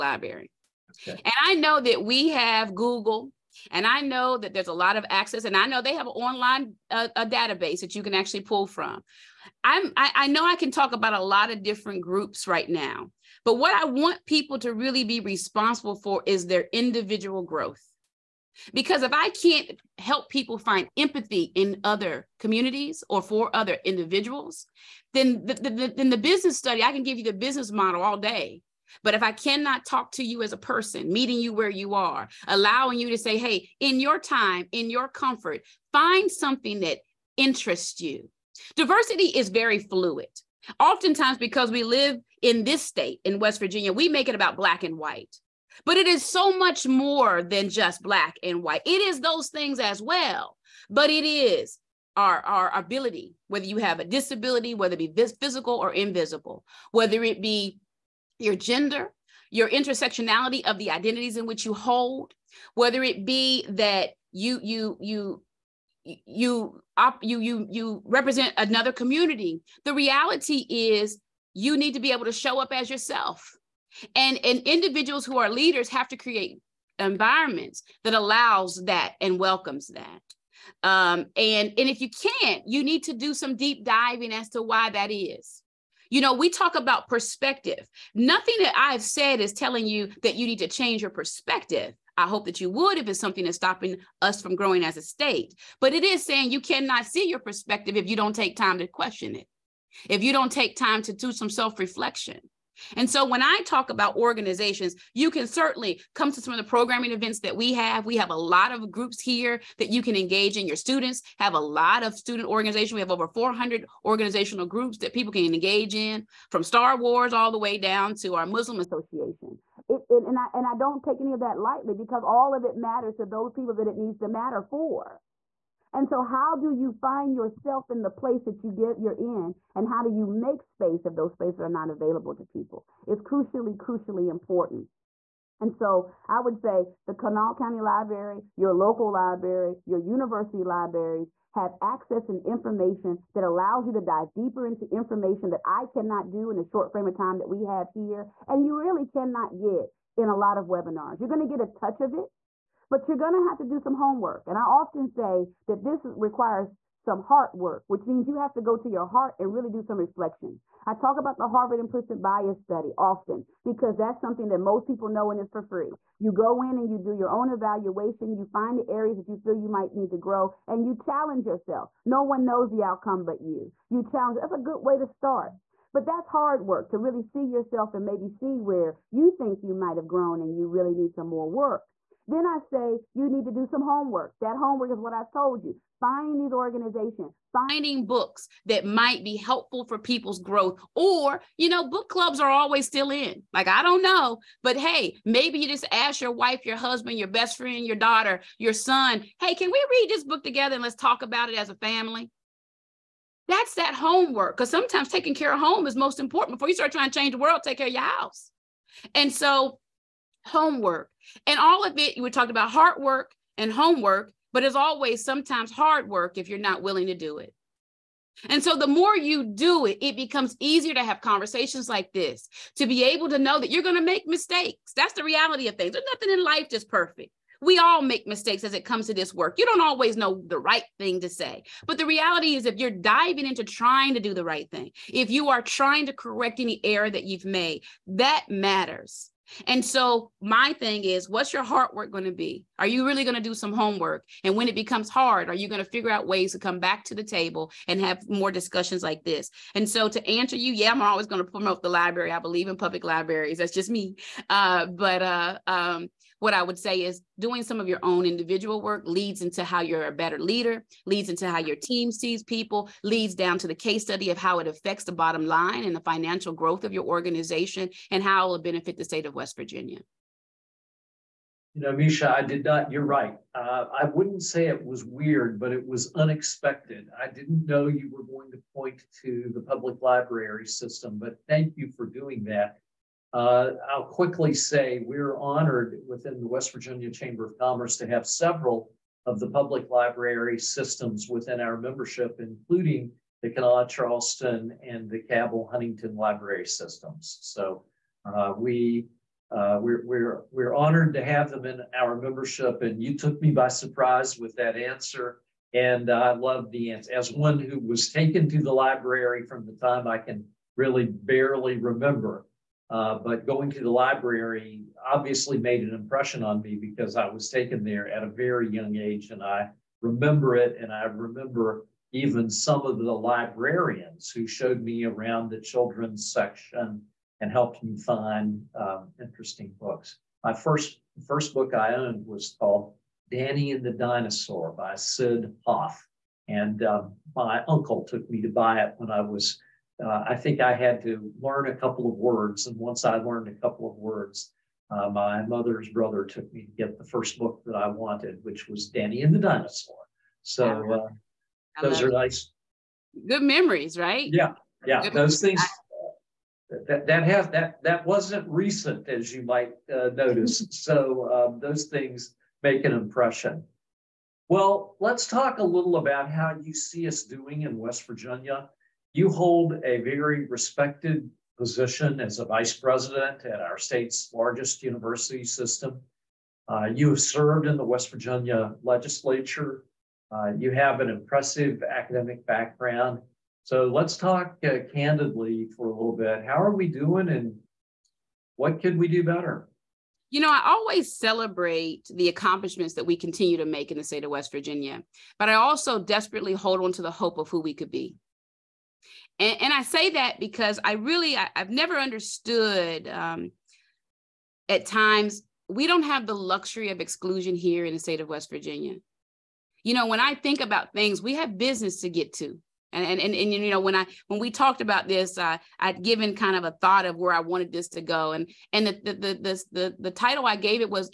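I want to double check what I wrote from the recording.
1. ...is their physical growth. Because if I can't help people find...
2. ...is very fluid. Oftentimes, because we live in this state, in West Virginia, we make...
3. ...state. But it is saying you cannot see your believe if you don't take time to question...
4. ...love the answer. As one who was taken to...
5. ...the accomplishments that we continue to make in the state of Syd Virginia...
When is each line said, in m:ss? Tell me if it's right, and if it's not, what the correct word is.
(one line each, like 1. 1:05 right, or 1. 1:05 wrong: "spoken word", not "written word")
1. 0:16 wrong: "individual", not "physical"
2. 0:39 right
3. 1:35 wrong: "perspective", not "believe"
4. 5:06 right
5. 6:32 wrong: "West", not "Syd".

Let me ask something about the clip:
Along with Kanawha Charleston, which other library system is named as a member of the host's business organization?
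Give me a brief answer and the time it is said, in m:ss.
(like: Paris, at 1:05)
Cabell Huntington, at 4:55.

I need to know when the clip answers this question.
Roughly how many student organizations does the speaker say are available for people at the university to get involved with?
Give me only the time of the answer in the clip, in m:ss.
1:53.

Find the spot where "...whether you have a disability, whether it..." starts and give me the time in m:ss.
0:53.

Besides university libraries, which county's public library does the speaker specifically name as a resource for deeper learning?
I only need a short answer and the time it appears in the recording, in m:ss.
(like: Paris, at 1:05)
Kanawha County Library, at 2:17.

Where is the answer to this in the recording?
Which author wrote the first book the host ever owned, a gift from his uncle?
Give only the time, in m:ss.
5:34.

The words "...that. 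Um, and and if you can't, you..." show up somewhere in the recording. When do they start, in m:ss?
1:19.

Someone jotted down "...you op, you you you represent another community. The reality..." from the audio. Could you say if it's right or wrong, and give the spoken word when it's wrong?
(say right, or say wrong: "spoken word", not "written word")
right.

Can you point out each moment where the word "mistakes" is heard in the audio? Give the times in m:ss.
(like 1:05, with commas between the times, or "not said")
3:44, 3:48.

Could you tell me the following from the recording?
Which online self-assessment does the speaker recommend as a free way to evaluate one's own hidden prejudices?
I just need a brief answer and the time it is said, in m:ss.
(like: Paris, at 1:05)
Harvard implicit bias study, at 2:41.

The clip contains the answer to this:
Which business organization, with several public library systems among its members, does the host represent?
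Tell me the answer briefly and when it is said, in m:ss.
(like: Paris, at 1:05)
West Virginia Chamber of Commerce, at 4:46.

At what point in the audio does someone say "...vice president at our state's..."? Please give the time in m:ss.
6:12.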